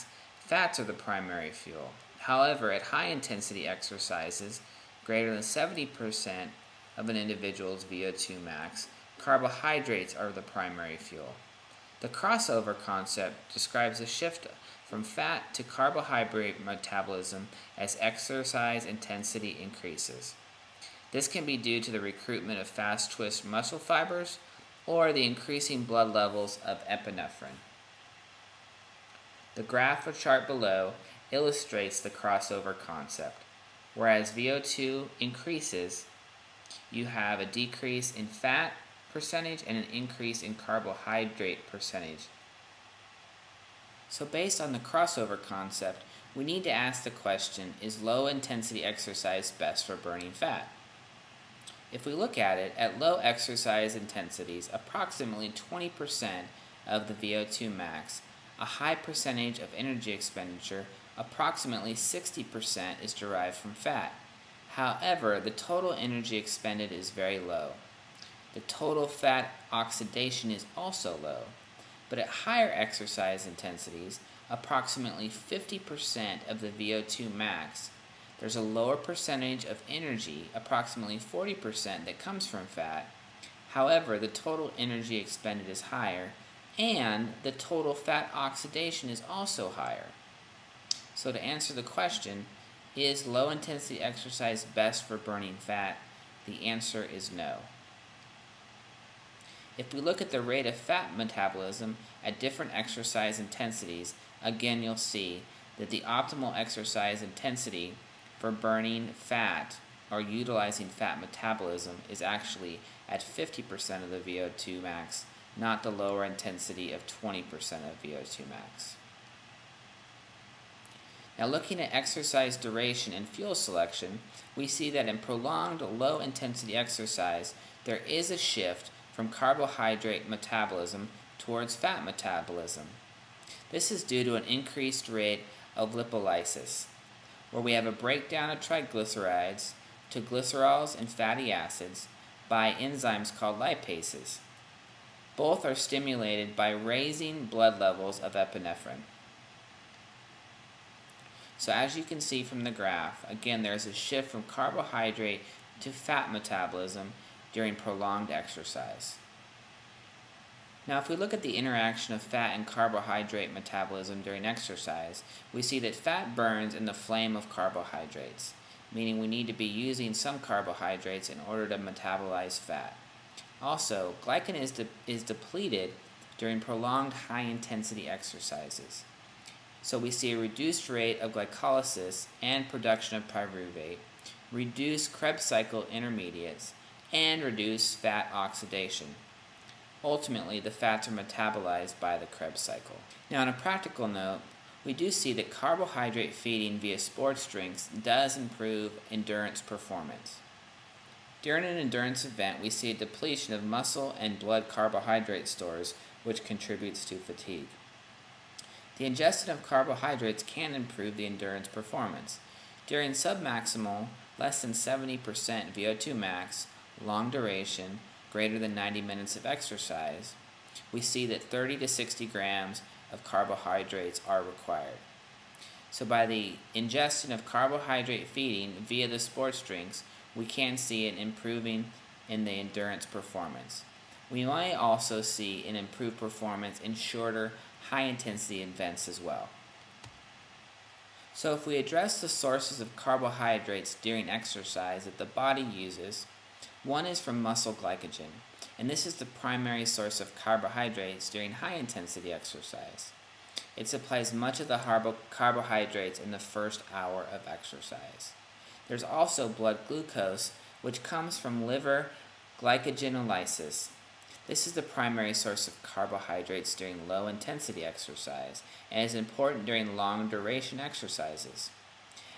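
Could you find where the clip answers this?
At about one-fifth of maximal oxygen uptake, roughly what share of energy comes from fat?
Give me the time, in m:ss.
1:01.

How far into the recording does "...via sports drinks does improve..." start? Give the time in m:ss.
3:16.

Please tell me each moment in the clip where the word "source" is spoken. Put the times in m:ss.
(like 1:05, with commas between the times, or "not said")
4:02, 4:09, 4:25.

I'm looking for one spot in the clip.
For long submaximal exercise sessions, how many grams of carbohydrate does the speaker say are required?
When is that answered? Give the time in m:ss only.
3:41.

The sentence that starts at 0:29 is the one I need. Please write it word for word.
The graph or chart below illustrates the crossover concept.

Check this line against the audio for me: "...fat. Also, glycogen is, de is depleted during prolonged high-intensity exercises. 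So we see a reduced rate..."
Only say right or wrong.
right.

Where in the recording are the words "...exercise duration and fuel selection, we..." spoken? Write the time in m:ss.
2:01.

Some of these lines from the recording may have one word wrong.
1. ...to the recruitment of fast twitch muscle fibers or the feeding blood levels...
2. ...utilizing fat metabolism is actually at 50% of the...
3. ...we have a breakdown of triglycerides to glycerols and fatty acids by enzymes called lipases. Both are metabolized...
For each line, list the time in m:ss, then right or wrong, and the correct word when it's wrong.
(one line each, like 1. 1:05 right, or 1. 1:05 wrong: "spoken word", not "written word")
1. 0:21 wrong: "increasing", not "feeding"
2. 1:50 right
3. 2:17 wrong: "stimulated", not "metabolized".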